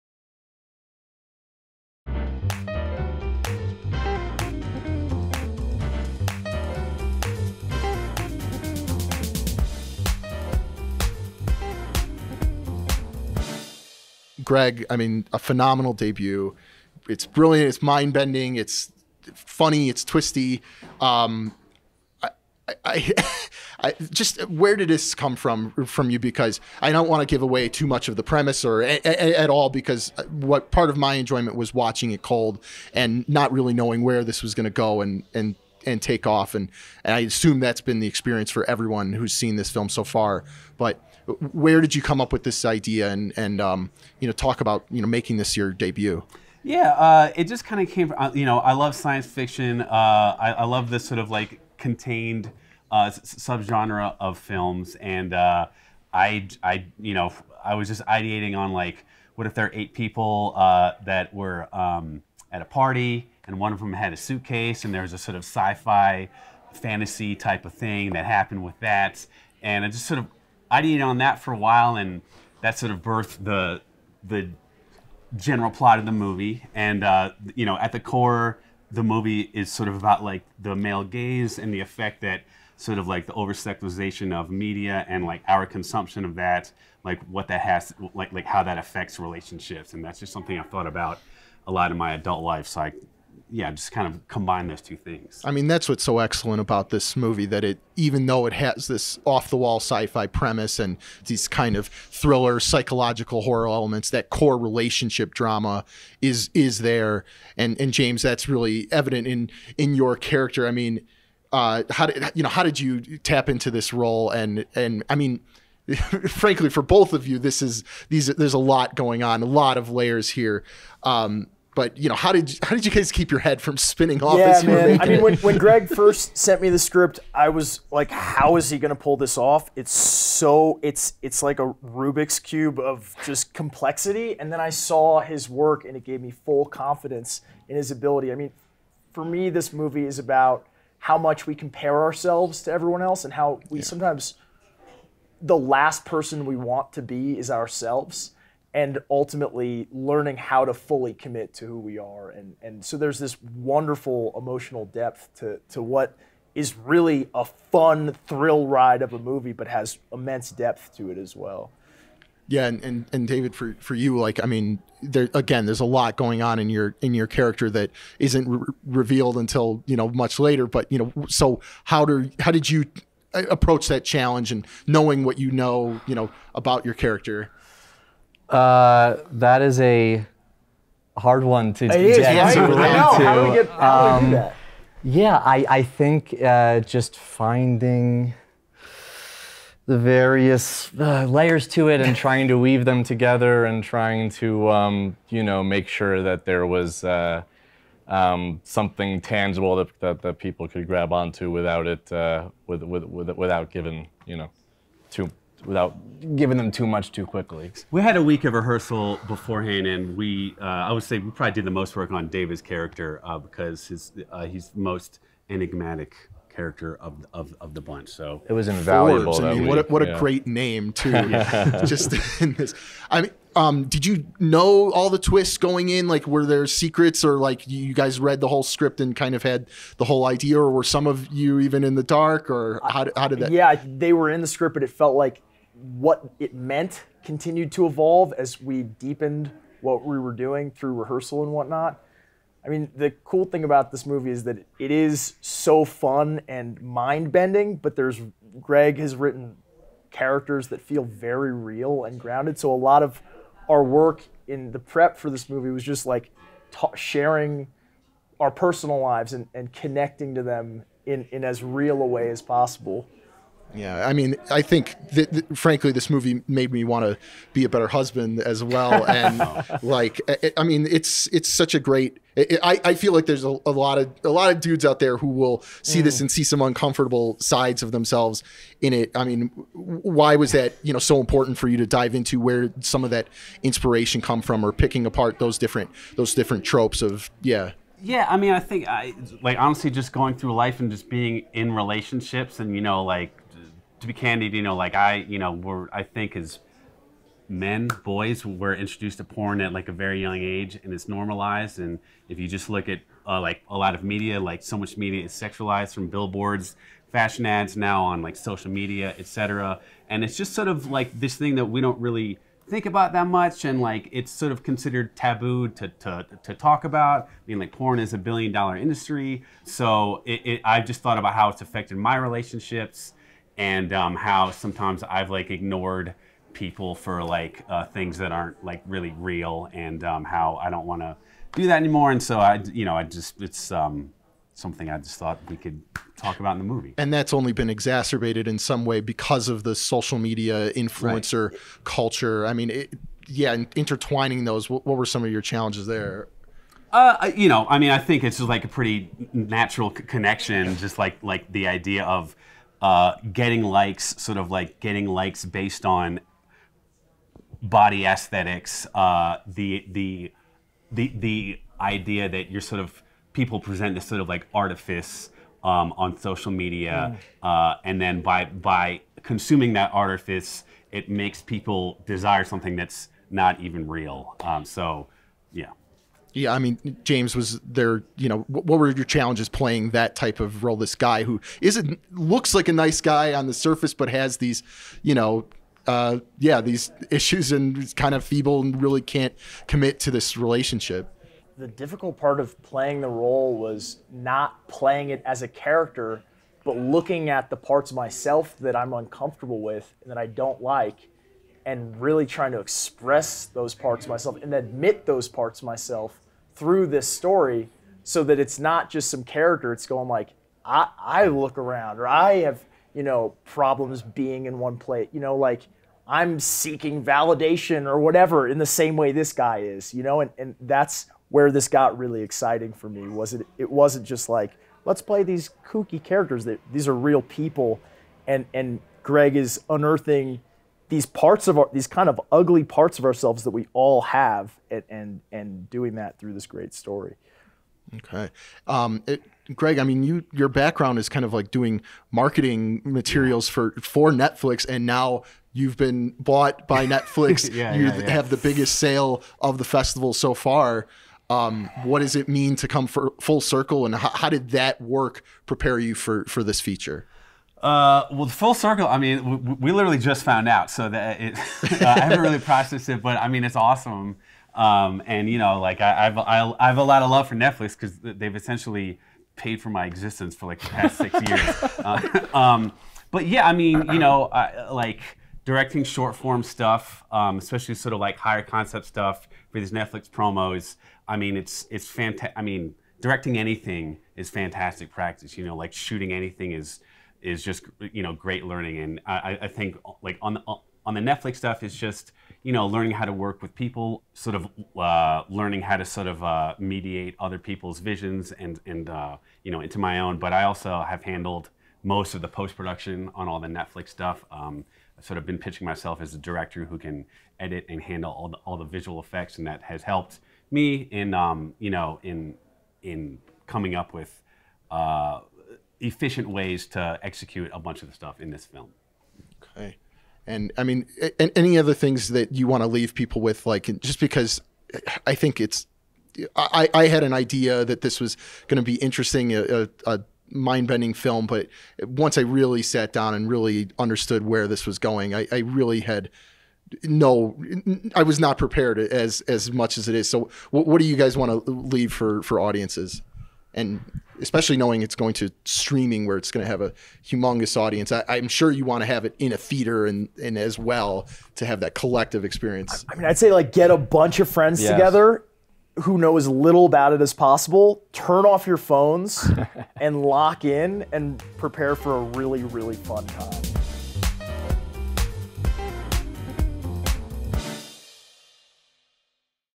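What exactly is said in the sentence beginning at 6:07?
uh, and then by, by consuming that artifice, it makes people desire something that's not even real.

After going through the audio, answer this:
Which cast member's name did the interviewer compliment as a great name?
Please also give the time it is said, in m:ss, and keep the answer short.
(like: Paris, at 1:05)
Forbes, at 3:39.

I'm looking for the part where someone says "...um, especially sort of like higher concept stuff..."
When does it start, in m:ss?
7:57.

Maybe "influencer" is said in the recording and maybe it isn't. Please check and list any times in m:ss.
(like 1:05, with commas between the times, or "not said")
5:40.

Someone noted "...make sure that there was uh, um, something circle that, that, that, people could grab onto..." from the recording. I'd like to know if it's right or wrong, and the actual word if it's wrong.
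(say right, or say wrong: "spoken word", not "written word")
wrong: "tangible", not "circle".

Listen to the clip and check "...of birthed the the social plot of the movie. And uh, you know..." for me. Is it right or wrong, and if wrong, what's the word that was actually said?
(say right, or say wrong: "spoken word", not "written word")
wrong: "general", not "social".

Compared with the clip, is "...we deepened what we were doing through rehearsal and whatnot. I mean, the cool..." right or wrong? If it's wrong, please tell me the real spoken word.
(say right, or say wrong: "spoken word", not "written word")
right.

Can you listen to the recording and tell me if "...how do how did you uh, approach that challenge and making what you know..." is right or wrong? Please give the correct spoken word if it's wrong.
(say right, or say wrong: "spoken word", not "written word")
wrong: "knowing", not "making".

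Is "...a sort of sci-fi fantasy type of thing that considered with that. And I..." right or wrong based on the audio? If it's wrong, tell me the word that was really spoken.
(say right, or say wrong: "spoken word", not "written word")
wrong: "happened", not "considered".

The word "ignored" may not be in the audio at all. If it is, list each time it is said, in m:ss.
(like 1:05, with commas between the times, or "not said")
5:25.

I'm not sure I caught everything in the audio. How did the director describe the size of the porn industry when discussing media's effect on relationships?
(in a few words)
Billion dollar industry.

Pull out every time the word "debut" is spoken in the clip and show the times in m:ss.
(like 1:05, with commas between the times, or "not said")
0:15, 0:45.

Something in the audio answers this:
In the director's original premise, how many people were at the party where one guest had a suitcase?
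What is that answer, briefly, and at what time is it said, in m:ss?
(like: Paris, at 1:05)
8, at 0:59.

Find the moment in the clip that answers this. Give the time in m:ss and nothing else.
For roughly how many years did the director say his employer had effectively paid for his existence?
7:50.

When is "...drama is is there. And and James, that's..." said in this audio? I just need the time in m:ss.
1:45.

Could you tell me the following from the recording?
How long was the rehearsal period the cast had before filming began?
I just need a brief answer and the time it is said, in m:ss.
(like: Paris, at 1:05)
A week, at 3:28.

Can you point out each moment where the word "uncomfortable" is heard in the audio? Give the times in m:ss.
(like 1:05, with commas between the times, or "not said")
4:36, 6:38.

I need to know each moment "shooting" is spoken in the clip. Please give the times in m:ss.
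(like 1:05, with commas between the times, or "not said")
8:05.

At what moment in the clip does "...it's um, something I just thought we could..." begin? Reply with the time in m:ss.
5:33.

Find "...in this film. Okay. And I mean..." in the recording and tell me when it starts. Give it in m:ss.
8:38.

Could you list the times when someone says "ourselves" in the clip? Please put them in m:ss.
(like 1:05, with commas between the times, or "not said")
2:22, 2:27, 7:13.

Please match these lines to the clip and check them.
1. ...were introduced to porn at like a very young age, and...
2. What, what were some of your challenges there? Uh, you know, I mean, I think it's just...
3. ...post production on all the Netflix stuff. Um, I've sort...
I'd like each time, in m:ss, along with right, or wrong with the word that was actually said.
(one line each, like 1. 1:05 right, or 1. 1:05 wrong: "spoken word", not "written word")
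1. 4:58 right
2. 5:44 right
3. 8:22 right.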